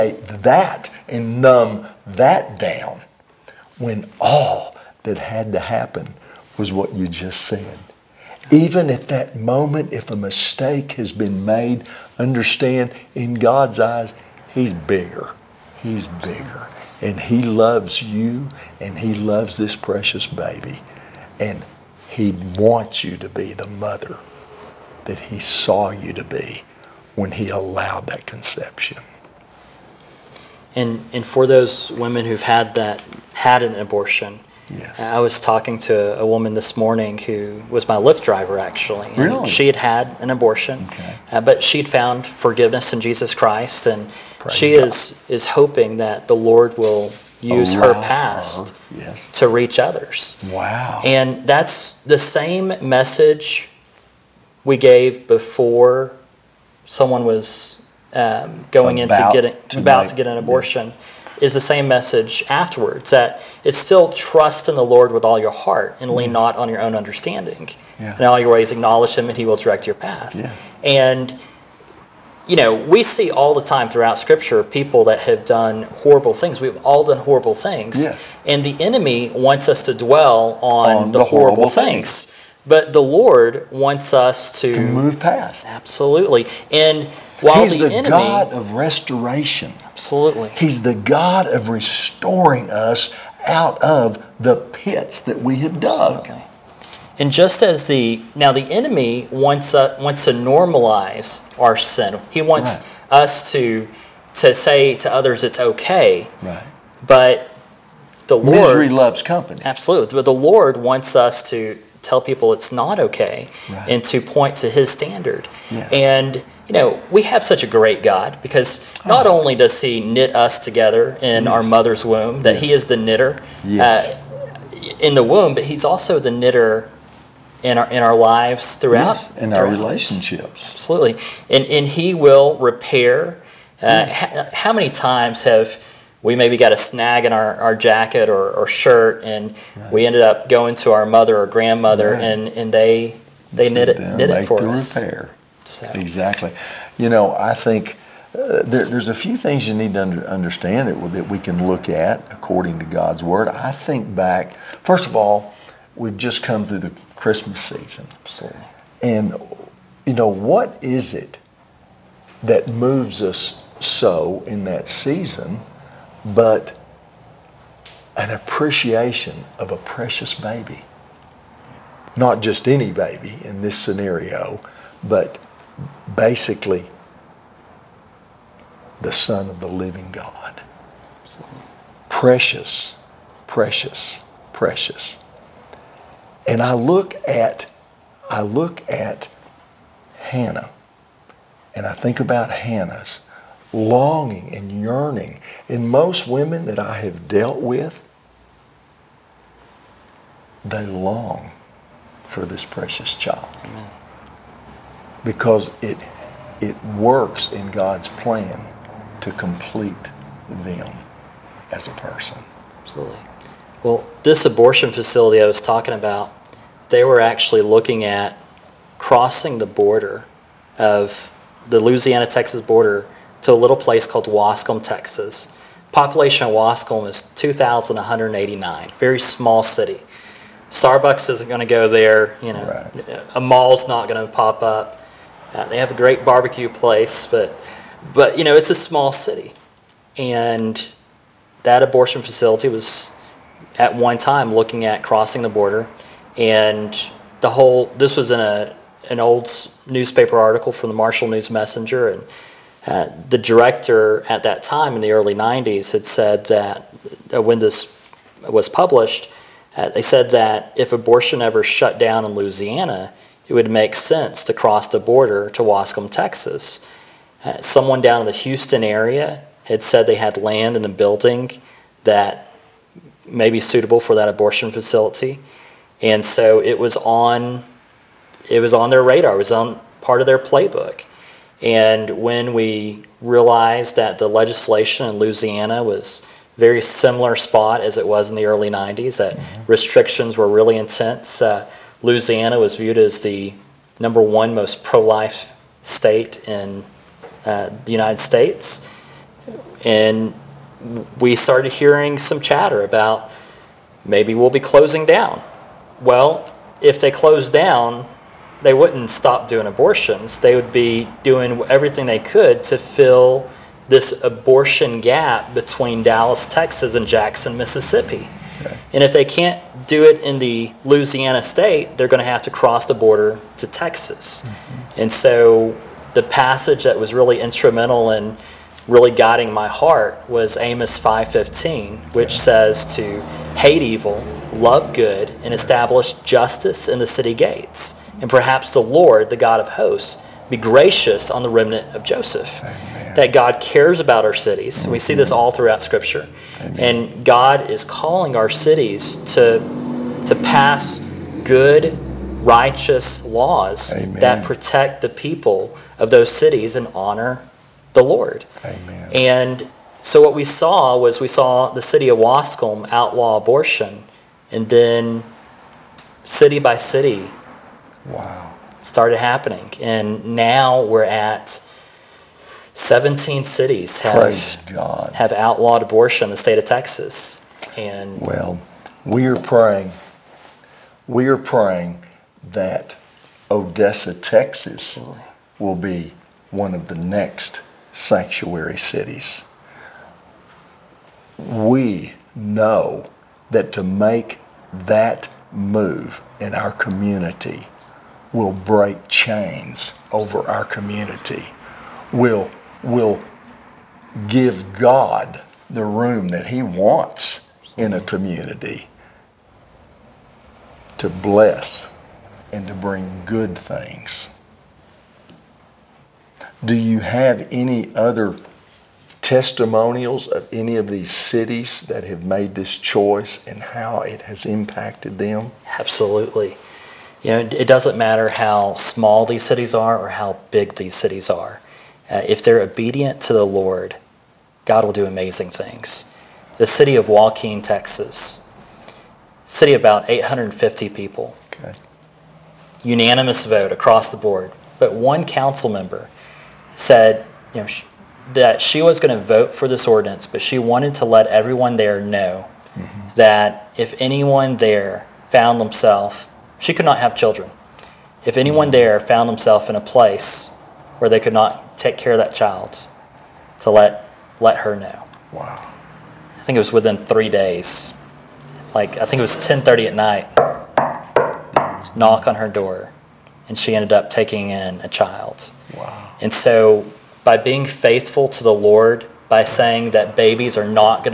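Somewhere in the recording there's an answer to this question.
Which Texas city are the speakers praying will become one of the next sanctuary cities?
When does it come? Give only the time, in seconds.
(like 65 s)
383 s.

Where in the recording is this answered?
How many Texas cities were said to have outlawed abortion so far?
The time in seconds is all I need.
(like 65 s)
372 s.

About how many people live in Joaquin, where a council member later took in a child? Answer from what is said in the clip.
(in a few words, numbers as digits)
850.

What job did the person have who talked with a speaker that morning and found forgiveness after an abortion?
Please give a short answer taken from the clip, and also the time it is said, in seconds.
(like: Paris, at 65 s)
Lyft driver, at 37 s.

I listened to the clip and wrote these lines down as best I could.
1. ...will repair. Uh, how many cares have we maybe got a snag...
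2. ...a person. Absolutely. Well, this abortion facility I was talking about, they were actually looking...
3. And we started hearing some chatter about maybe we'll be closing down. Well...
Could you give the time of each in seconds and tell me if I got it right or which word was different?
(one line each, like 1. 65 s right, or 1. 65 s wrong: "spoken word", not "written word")
1. 132 s wrong: "times", not "cares"
2. 211 s right
3. 299 s right.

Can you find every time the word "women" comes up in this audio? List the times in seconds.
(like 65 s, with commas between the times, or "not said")
31 s, 196 s.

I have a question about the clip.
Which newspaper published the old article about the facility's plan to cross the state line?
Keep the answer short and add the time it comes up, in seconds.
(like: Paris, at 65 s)
Marshall News Messenger, at 250 s.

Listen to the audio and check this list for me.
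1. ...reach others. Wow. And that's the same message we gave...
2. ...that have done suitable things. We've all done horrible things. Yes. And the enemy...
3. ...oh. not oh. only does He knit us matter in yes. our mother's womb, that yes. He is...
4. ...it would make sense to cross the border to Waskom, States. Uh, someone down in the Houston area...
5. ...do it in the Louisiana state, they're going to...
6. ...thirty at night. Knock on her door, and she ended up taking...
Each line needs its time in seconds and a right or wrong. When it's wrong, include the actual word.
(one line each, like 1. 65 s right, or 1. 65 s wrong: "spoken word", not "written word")
1. 49 s right
2. 75 s wrong: "horrible", not "suitable"
3. 119 s wrong: "together", not "matter"
4. 263 s wrong: "Texas", not "States"
5. 319 s right
6. 469 s right.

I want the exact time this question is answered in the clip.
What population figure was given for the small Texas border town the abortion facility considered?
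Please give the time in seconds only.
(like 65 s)
227 s.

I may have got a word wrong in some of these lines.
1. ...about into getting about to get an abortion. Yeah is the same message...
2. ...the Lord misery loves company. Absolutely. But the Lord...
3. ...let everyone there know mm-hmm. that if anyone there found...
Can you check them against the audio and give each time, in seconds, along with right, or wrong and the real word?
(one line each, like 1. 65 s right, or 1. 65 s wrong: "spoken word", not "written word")
1. 58 s right
2. 108 s right
3. 451 s right.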